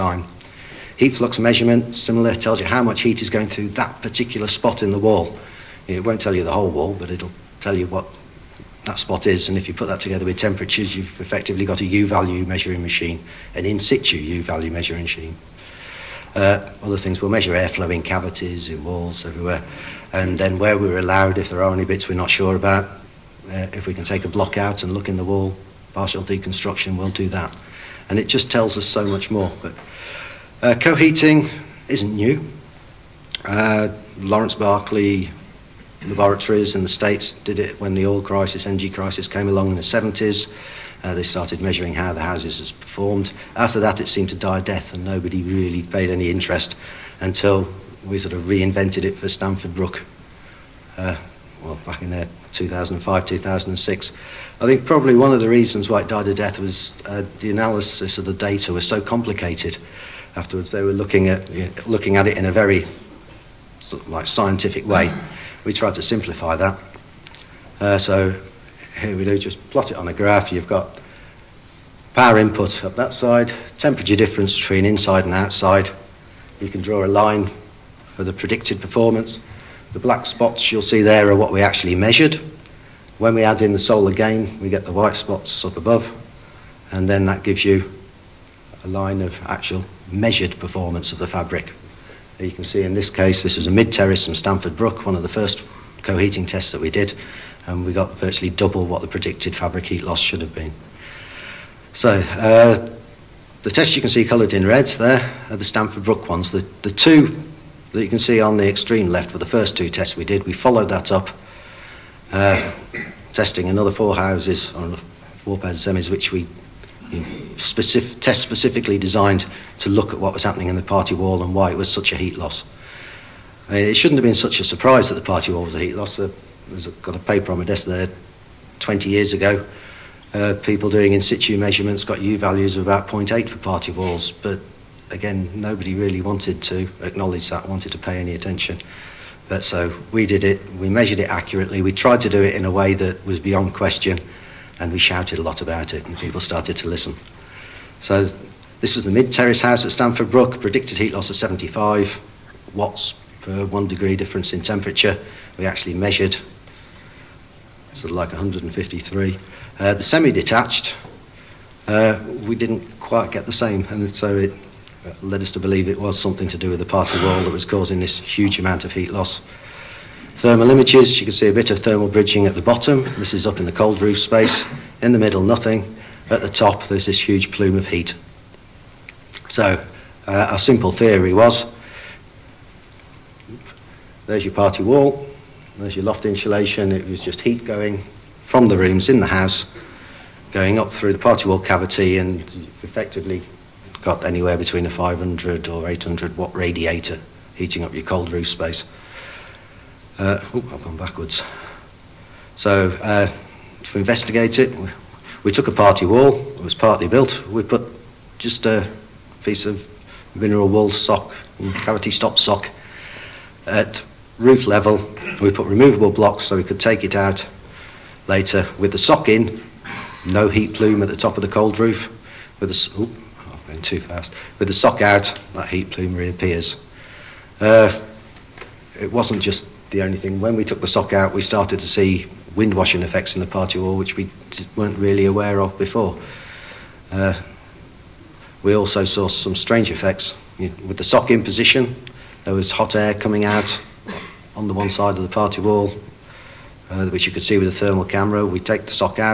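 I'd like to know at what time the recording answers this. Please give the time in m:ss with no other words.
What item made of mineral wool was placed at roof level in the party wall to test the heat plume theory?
3:31.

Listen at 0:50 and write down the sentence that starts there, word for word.
Uh, well, back in there, 2005, 2006.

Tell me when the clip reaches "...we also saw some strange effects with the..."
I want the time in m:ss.
3:58.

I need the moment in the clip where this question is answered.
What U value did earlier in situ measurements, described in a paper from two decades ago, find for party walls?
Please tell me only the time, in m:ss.
2:13.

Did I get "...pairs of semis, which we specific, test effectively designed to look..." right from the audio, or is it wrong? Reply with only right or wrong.
wrong.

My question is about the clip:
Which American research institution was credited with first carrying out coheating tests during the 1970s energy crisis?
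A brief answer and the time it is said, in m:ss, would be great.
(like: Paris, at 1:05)
Lawrence Berkeley laboratories, at 0:34.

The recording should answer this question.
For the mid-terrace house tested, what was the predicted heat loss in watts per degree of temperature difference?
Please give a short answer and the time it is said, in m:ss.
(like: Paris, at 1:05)
75, at 2:31.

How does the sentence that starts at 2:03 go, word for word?
I mean, it shouldn't have been such a surprise that the party wall was a heat loss.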